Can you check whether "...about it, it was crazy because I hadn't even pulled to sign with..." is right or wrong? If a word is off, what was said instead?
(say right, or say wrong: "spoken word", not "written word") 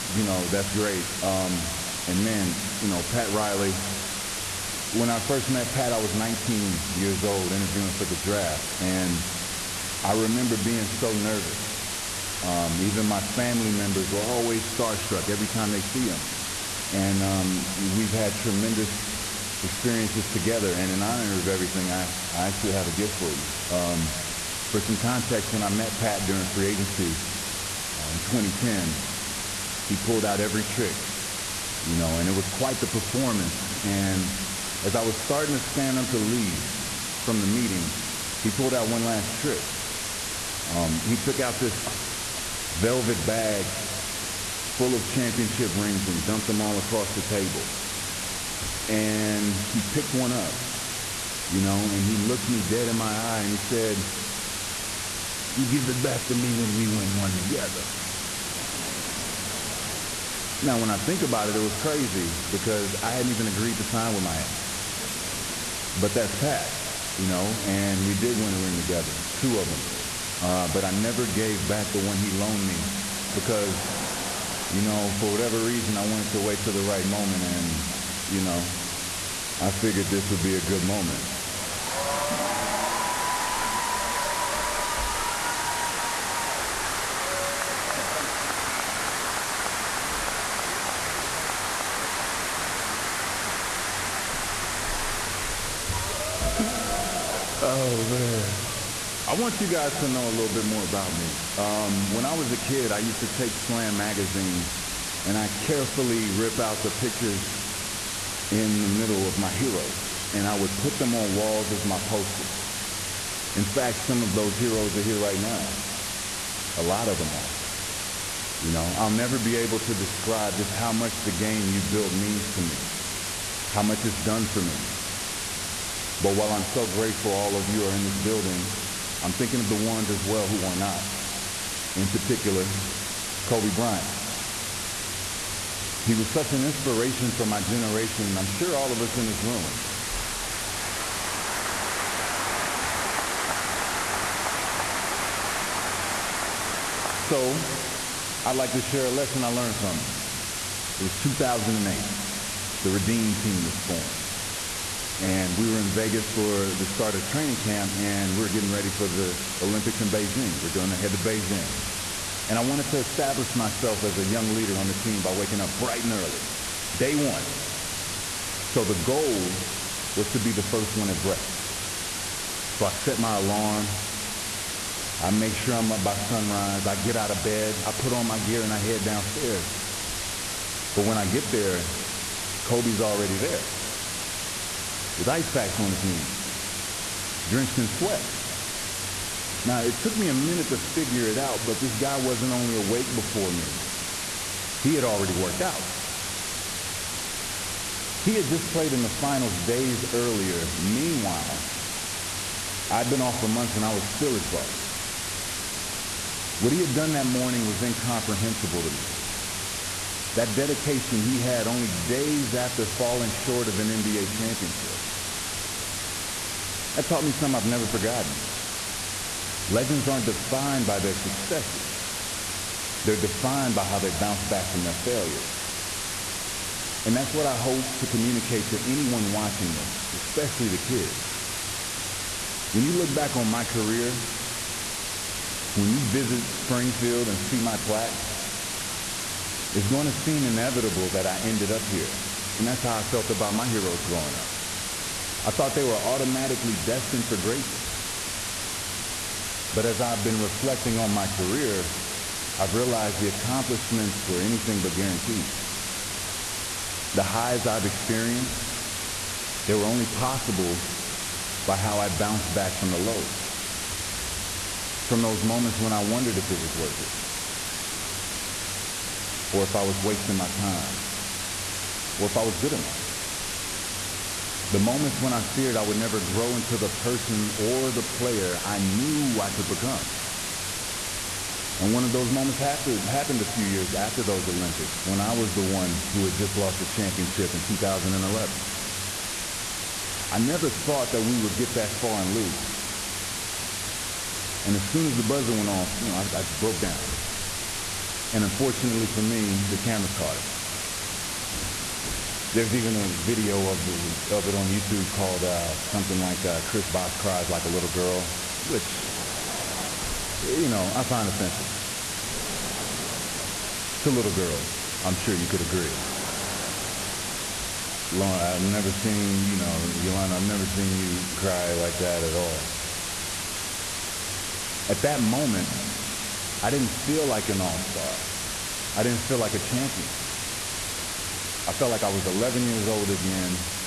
wrong: "agreed", not "pulled".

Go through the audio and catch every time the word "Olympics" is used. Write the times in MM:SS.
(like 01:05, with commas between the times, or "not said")
02:39, 04:44.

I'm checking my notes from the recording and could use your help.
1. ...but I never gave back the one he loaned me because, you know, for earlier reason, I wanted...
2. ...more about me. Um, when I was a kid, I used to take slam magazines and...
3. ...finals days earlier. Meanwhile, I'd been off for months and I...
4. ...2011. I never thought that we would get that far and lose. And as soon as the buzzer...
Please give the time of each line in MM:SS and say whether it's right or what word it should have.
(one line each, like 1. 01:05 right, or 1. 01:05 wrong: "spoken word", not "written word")
1. 01:10 wrong: "whatever", not "earlier"
2. 01:40 right
3. 03:19 right
4. 04:47 right.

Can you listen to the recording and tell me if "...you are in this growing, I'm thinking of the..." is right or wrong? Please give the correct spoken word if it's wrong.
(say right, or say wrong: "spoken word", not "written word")
wrong: "building", not "growing".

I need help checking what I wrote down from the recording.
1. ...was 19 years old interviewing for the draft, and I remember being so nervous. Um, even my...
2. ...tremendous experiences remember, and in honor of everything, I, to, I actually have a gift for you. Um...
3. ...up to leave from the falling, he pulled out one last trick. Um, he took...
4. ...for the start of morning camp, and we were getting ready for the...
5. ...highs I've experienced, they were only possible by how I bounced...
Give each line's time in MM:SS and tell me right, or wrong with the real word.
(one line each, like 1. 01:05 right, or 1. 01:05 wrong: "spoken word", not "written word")
1. 00:05 right
2. 00:18 wrong: "together", not "remember"
3. 00:35 wrong: "meeting", not "falling"
4. 02:36 wrong: "training", not "morning"
5. 04:17 right.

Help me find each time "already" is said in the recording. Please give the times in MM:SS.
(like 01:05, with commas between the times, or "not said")
03:03, 03:15.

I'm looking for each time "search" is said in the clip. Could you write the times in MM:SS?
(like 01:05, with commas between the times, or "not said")
not said.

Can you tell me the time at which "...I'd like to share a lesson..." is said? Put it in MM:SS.
02:28.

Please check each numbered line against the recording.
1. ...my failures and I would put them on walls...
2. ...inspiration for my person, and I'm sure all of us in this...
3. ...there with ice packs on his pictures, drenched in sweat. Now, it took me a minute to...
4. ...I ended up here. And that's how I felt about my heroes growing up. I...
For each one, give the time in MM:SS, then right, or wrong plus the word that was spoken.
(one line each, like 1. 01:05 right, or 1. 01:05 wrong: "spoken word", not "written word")
1. 01:49 wrong: "heroes", not "failures"
2. 02:16 wrong: "generation", not "person"
3. 03:03 wrong: "knees", not "pictures"
4. 04:01 right.